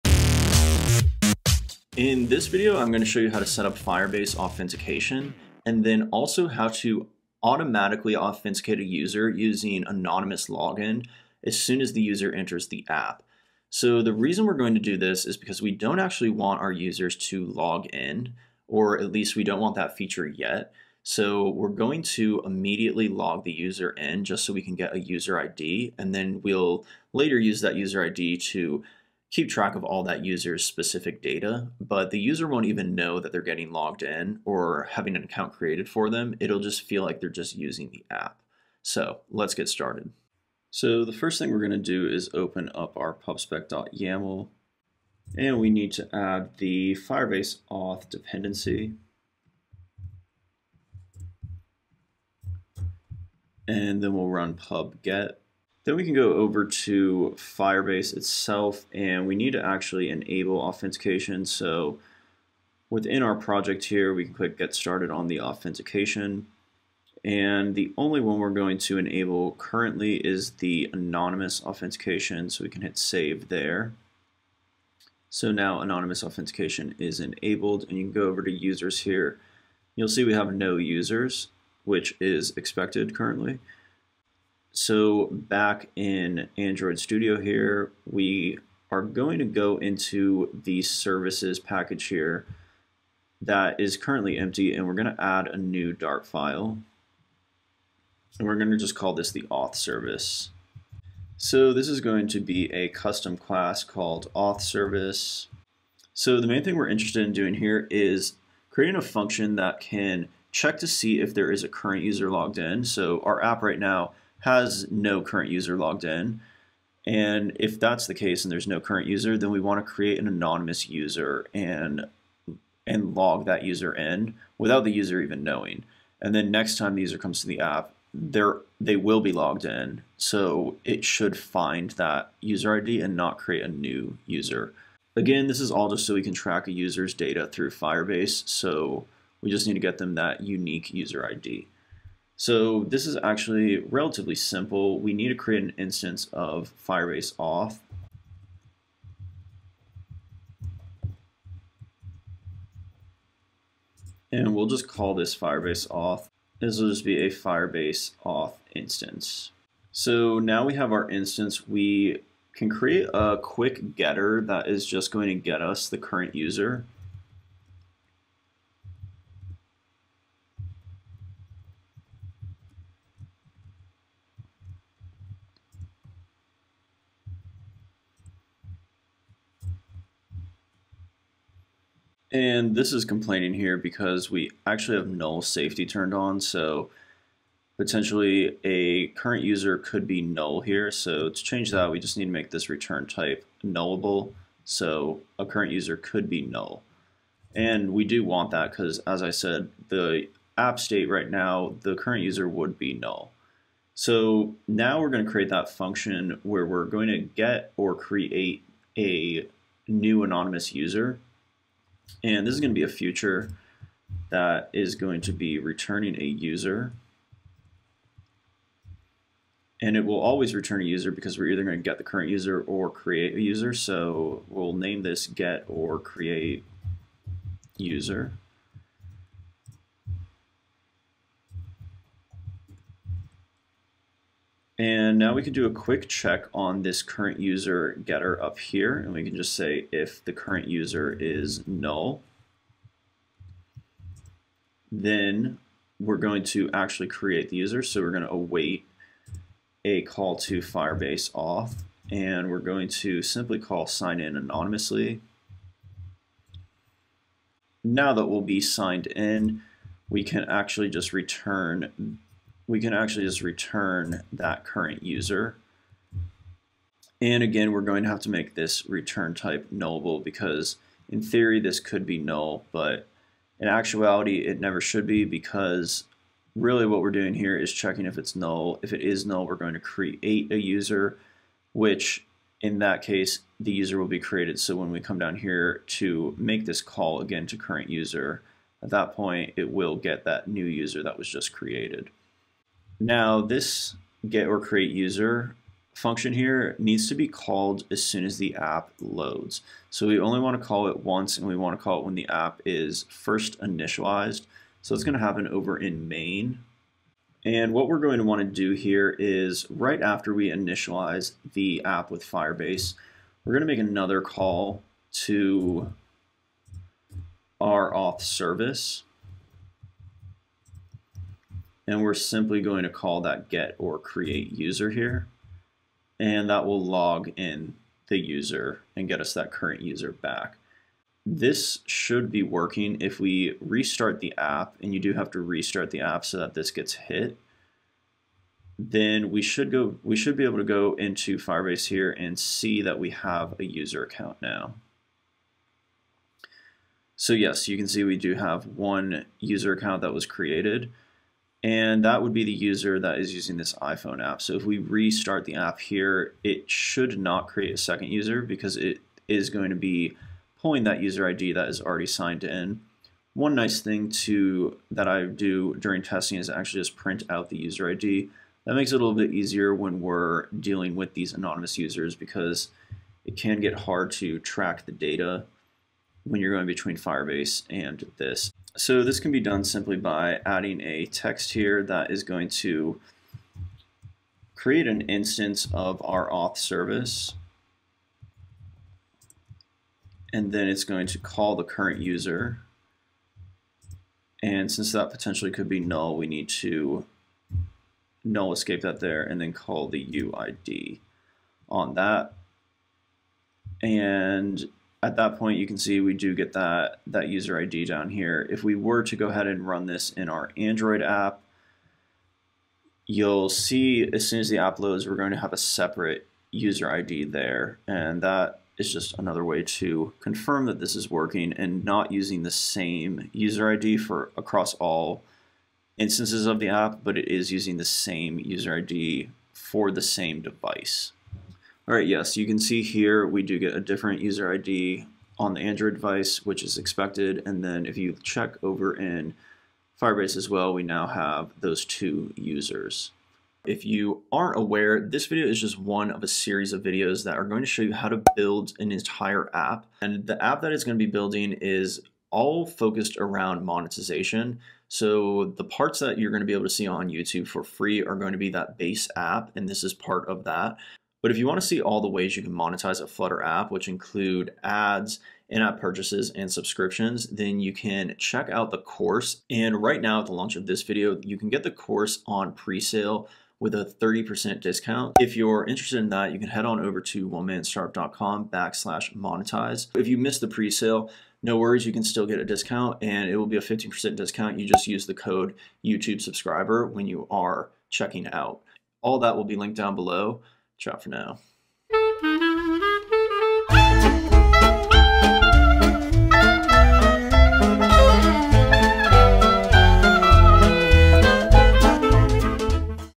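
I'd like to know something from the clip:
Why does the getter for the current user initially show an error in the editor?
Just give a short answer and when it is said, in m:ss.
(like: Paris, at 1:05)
null safety, at 3:05.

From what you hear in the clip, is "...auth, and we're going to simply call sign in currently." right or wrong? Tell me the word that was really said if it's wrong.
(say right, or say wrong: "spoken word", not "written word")
wrong: "anonymously", not "currently".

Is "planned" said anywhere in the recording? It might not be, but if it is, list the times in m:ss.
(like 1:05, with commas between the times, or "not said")
not said.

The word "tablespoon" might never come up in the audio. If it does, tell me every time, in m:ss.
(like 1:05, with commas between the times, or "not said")
not said.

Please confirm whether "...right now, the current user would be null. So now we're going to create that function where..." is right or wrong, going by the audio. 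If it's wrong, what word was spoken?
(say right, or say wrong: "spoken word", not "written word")
right.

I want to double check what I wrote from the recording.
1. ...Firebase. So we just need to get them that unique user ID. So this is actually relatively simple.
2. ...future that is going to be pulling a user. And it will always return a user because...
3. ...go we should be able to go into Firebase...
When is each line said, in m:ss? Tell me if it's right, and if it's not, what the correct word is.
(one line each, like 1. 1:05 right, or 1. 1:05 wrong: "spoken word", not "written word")
1. 2:17 right
2. 3:32 wrong: "returning", not "pulling"
3. 5:39 right.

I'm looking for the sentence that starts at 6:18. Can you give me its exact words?
So this can be done simply by adding a text here that is going to create an instance of our auth service.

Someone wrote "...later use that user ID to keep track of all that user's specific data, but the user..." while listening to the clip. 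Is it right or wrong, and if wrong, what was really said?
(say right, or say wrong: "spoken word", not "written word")
right.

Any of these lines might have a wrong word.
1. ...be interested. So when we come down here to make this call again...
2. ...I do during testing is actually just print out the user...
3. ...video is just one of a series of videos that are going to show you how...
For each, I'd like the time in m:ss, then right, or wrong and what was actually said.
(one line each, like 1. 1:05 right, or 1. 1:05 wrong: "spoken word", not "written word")
1. 4:44 wrong: "created", not "interested"
2. 6:05 right
3. 7:25 right.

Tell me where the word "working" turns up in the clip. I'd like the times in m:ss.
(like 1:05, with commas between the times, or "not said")
5:32, 7:01.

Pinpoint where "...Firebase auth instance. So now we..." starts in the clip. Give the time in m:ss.
2:37.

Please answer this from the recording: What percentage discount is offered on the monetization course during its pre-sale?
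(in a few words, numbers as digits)
30%.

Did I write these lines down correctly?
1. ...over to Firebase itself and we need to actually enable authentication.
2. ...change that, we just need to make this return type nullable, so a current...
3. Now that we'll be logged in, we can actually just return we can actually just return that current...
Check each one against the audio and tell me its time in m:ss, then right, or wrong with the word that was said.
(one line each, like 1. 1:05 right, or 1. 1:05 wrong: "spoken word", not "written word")
1. 0:56 right
2. 3:11 right
3. 4:17 wrong: "signed", not "logged".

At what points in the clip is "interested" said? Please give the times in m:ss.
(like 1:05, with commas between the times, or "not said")
1:46, 7:55.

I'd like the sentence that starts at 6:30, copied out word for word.
And then it's going to call the current user.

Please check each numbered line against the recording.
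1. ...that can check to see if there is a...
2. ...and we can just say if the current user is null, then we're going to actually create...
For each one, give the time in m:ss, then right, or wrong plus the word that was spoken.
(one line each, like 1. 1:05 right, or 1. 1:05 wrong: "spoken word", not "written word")
1. 1:49 right
2. 3:58 right.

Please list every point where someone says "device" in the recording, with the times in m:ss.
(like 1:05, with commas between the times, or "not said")
7:10, 7:15.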